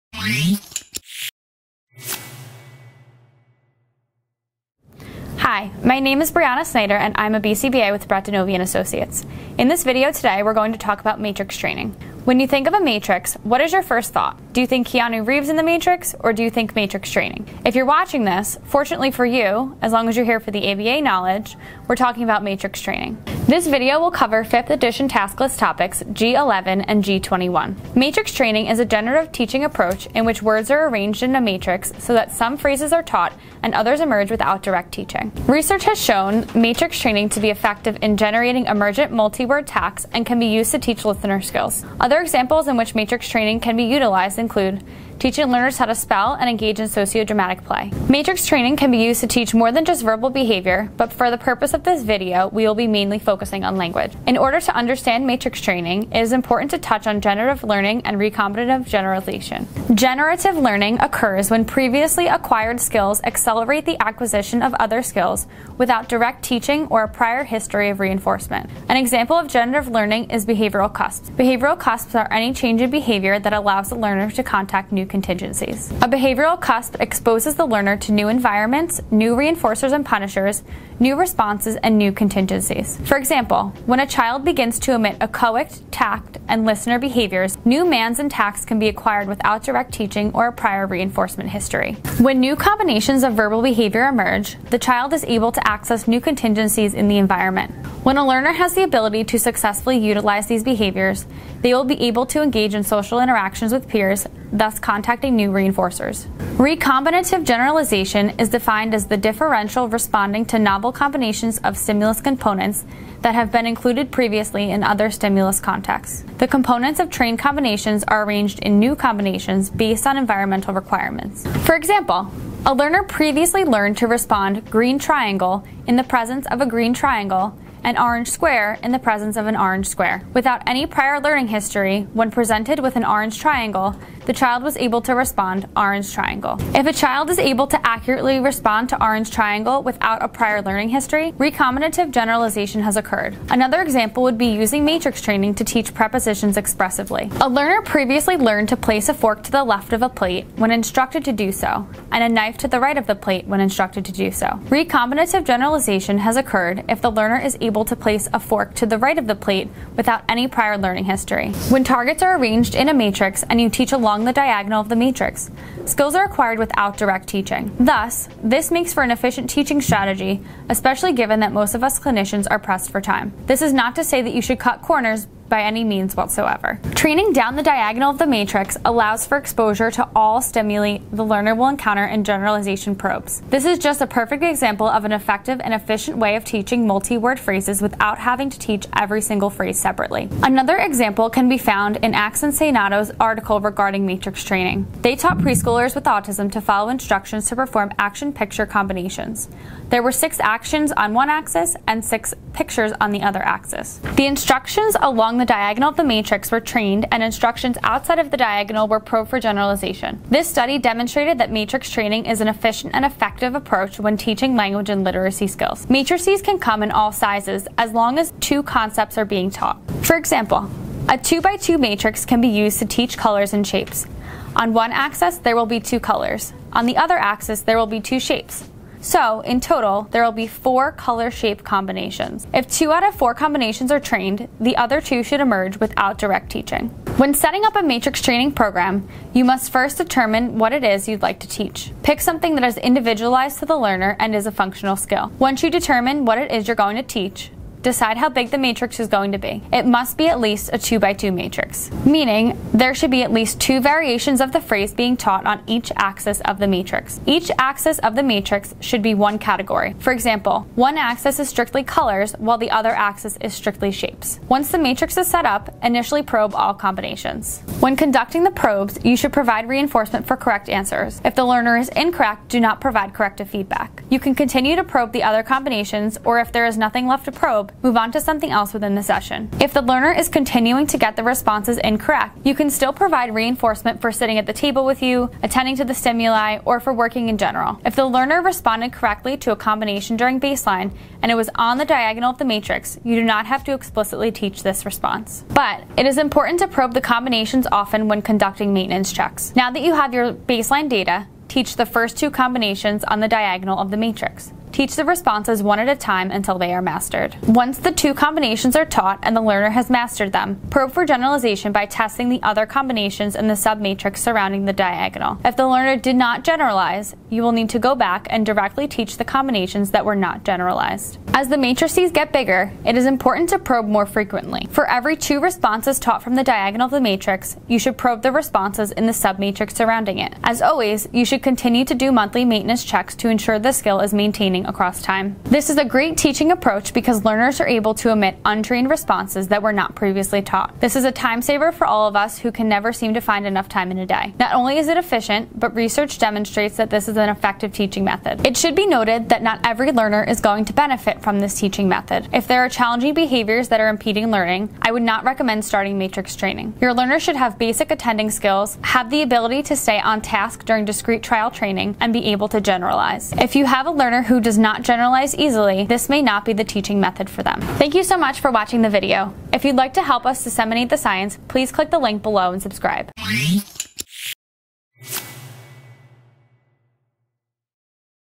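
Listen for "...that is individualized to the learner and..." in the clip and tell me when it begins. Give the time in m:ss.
4:02.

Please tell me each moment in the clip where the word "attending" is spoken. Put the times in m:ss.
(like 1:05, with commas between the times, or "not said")
4:45, 5:57.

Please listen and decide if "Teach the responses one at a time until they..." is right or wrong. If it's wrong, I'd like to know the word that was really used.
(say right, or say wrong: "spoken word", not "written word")
right.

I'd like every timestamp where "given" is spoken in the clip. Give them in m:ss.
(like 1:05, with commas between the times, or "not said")
2:51.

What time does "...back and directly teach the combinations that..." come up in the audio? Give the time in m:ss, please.
5:17.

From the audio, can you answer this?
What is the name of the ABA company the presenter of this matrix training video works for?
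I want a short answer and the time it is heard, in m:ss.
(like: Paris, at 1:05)
Brett DiNovi and Associates, at 0:08.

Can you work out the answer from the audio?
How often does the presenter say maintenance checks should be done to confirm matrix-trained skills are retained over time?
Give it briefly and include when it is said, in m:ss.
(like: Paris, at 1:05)
Monthly, at 5:32.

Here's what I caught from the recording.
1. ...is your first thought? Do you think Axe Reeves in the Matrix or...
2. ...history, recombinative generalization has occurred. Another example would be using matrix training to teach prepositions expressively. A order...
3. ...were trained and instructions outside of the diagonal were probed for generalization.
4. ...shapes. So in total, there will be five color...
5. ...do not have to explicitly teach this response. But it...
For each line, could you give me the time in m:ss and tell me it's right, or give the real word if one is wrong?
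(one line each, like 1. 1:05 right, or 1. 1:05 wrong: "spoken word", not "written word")
1. 0:13 wrong: "Keanu", not "Axe"
2. 2:20 wrong: "learner", not "order"
3. 3:26 right
4. 3:48 wrong: "four", not "five"
5. 4:53 right.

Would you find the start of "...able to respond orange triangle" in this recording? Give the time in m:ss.
2:14.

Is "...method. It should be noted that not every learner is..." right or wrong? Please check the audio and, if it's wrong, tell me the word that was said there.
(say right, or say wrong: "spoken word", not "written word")
right.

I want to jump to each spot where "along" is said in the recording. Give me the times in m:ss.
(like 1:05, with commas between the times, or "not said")
2:43, 3:25.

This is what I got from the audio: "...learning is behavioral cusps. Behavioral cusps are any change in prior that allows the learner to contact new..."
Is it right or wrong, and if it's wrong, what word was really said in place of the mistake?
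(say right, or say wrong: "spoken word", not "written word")
wrong: "behavior", not "prior".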